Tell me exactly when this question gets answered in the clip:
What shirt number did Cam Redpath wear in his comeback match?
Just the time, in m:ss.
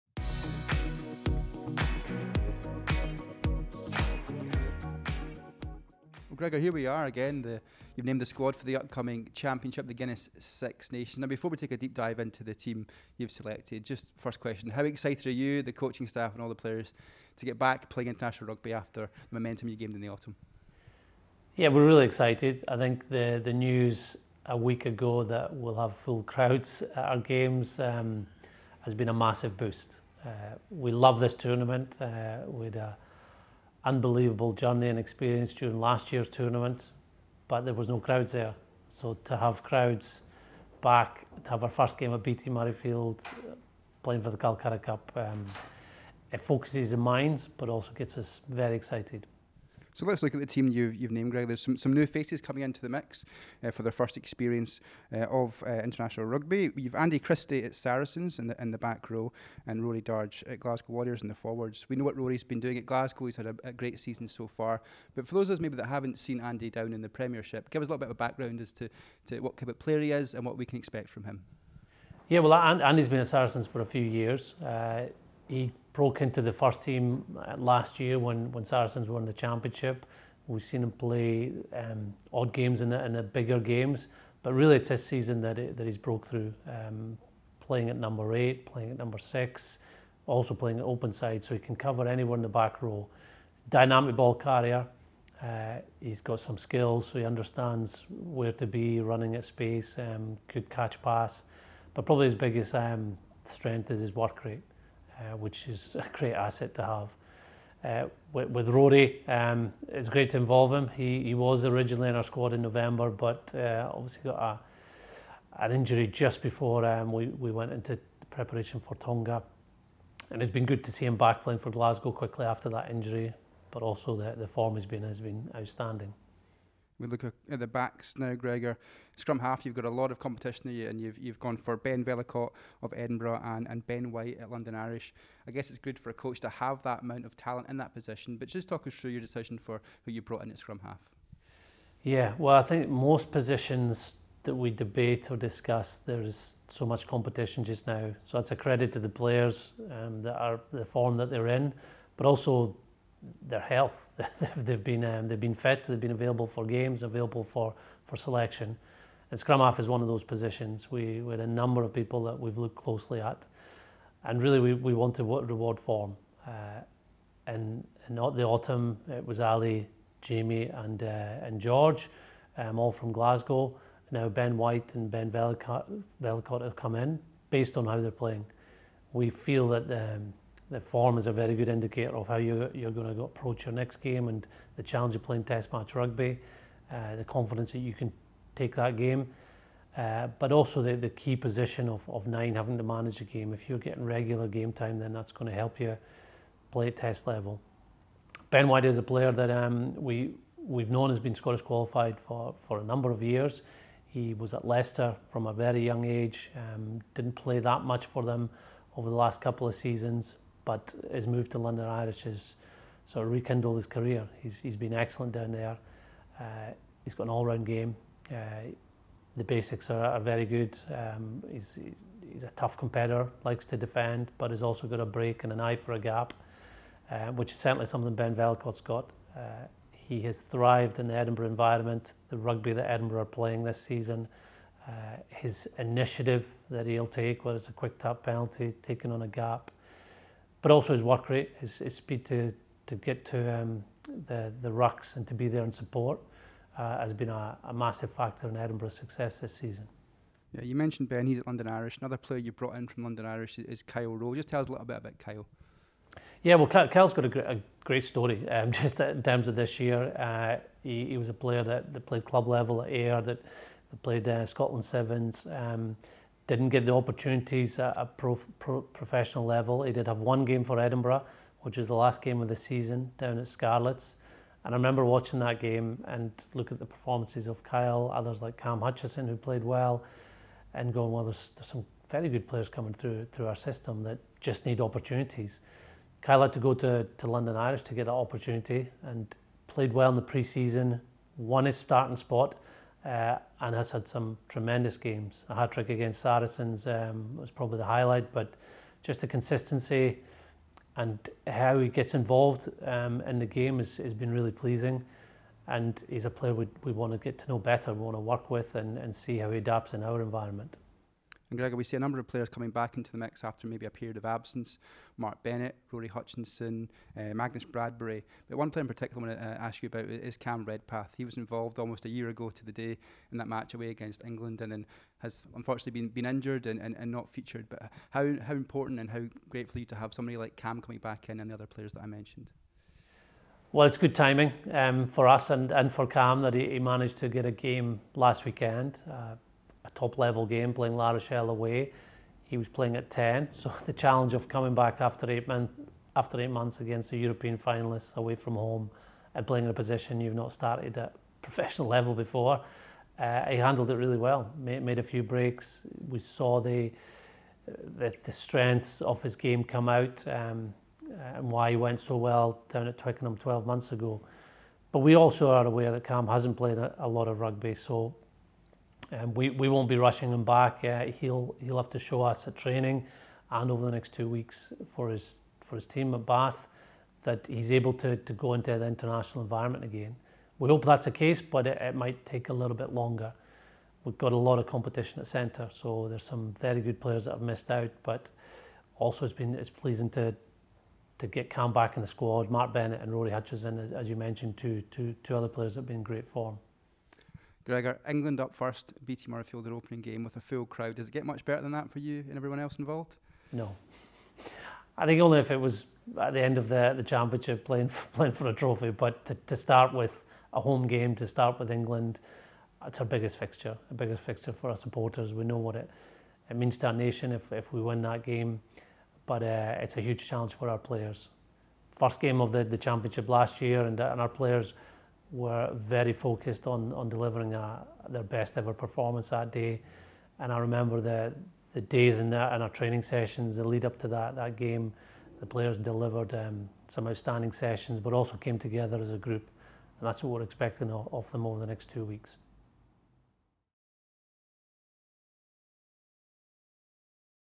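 5:42.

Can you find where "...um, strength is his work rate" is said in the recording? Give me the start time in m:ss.
1:42.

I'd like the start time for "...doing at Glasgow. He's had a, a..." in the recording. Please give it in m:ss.
1:02.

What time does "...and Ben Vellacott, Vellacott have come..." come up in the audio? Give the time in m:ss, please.
2:54.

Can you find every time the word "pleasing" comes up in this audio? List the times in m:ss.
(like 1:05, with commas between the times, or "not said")
5:04, 6:29.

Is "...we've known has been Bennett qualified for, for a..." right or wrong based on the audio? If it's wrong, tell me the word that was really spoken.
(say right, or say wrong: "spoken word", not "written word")
wrong: "Scottish", not "Bennett".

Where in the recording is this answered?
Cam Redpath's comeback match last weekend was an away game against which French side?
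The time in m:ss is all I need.
5:40.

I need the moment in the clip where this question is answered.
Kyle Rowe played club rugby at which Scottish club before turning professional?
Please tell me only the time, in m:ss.
4:22.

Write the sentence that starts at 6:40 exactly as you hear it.
Does it get much better than that for you and everyone else involved?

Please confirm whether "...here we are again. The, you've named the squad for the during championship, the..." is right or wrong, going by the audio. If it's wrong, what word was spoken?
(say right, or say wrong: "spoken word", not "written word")
wrong: "upcoming", not "during".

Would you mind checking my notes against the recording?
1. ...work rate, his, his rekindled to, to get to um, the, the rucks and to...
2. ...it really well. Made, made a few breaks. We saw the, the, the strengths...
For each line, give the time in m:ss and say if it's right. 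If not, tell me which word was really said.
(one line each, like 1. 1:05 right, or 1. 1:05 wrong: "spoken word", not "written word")
1. 4:01 wrong: "speed", not "rekindled"
2. 5:53 right.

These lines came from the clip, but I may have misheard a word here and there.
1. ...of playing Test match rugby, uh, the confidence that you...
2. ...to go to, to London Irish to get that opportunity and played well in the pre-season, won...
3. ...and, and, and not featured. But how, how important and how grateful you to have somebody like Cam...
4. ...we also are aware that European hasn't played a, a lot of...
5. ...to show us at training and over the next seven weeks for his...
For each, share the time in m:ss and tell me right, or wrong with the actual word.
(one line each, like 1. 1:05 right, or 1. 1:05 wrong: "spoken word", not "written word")
1. 3:05 right
2. 4:46 right
3. 5:26 right
4. 6:04 wrong: "Cam", not "European"
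5. 6:11 wrong: "two", not "seven".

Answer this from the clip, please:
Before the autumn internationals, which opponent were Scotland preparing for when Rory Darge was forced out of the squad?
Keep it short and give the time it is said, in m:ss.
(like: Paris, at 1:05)
Tonga, at 1:58.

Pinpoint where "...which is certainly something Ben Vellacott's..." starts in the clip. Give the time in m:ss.
3:47.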